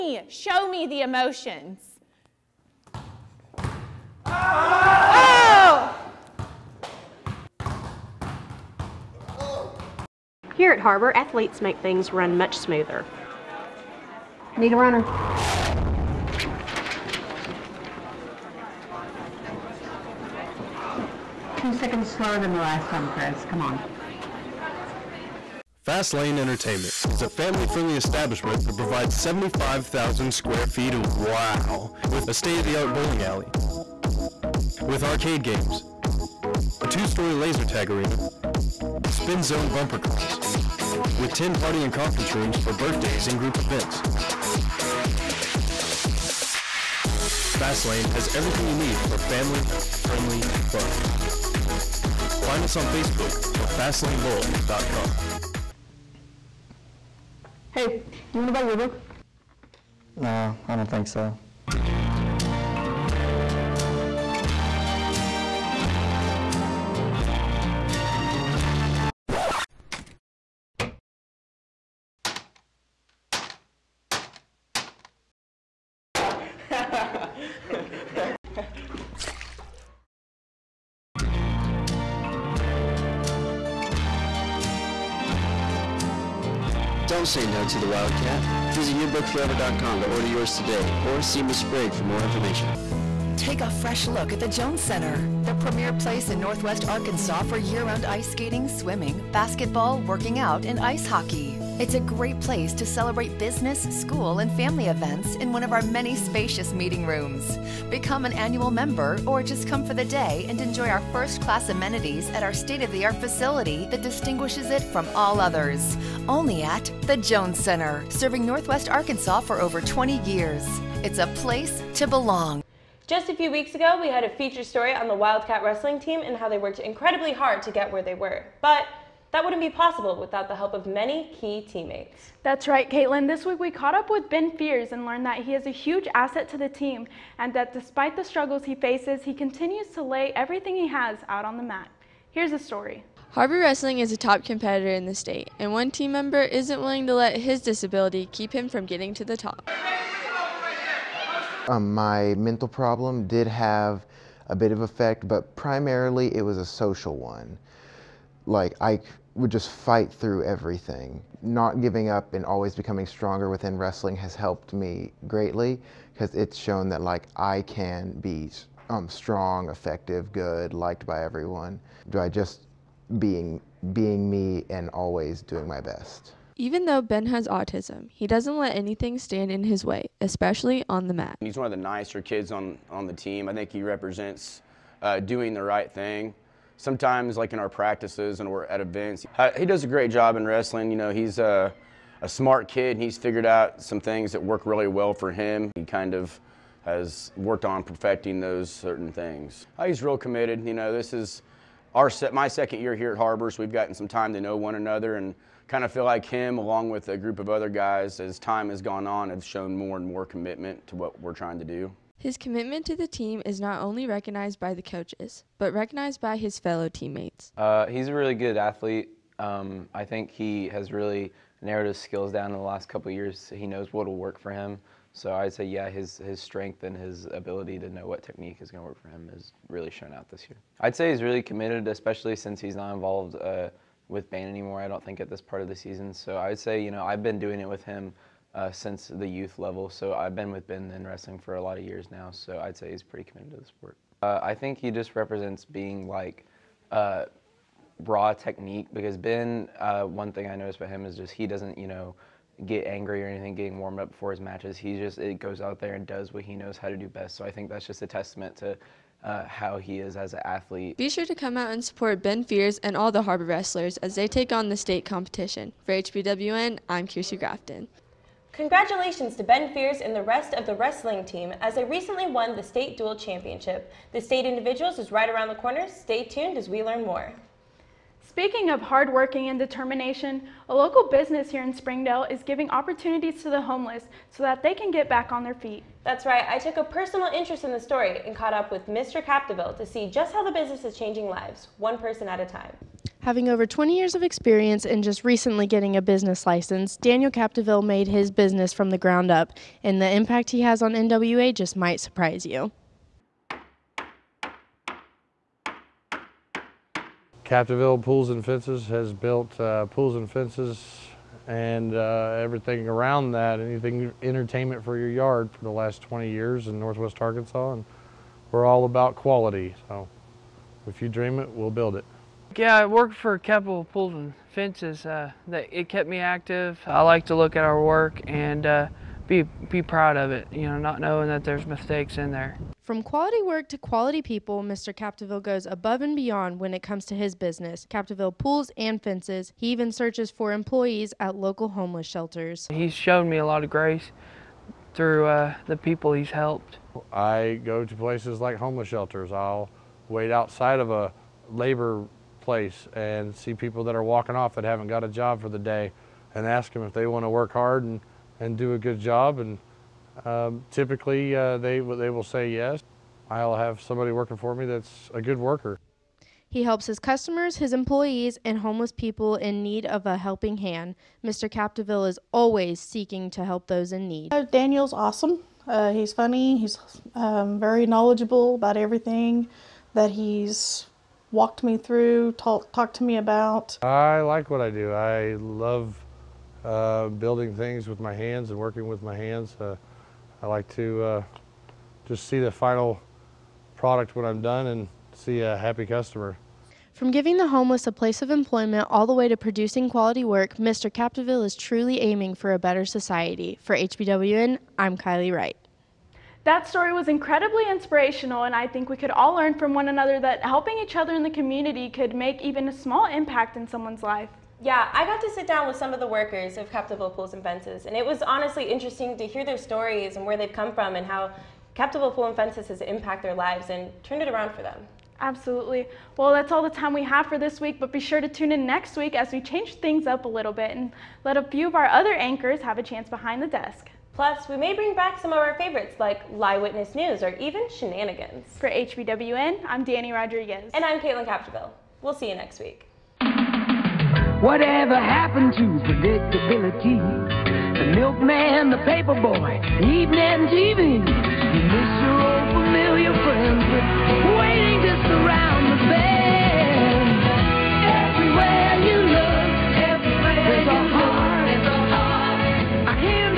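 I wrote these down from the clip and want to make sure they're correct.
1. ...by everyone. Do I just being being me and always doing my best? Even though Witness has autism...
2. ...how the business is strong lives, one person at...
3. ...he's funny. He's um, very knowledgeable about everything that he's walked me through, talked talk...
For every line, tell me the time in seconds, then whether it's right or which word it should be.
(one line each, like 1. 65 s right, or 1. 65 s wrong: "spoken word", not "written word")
1. 171 s wrong: "Ben", not "Witness"
2. 290 s wrong: "changing", not "strong"
3. 375 s right.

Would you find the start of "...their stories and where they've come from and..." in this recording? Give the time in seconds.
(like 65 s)
419 s.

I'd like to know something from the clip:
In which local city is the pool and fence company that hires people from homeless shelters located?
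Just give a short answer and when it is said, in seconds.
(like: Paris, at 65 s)
Springdale, at 281 s.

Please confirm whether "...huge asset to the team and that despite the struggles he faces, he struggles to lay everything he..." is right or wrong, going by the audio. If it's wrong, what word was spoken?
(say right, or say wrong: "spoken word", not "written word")
wrong: "continues", not "struggles".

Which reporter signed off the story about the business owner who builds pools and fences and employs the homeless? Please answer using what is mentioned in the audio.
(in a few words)
Kylie Wright.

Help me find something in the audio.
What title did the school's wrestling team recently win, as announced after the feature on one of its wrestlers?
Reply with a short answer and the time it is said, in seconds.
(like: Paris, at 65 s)
state dual championship, at 272 s.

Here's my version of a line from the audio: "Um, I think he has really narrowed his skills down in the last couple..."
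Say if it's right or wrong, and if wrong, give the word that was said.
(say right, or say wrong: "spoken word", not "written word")
right.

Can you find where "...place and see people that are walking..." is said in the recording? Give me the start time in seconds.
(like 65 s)
352 s.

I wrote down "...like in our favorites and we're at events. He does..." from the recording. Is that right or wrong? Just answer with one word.
wrong.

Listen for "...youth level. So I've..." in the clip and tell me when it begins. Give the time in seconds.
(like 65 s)
239 s.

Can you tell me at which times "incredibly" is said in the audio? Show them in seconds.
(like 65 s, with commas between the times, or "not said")
126 s, 407 s.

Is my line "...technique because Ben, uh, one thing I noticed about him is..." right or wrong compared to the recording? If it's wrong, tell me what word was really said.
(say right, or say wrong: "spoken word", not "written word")
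right.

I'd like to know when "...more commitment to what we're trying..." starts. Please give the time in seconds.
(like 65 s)
210 s.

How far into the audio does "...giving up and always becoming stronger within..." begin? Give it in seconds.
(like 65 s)
161 s.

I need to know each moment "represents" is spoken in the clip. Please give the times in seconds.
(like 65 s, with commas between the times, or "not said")
183 s, 245 s.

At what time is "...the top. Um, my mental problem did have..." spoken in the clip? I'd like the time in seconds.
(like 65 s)
149 s.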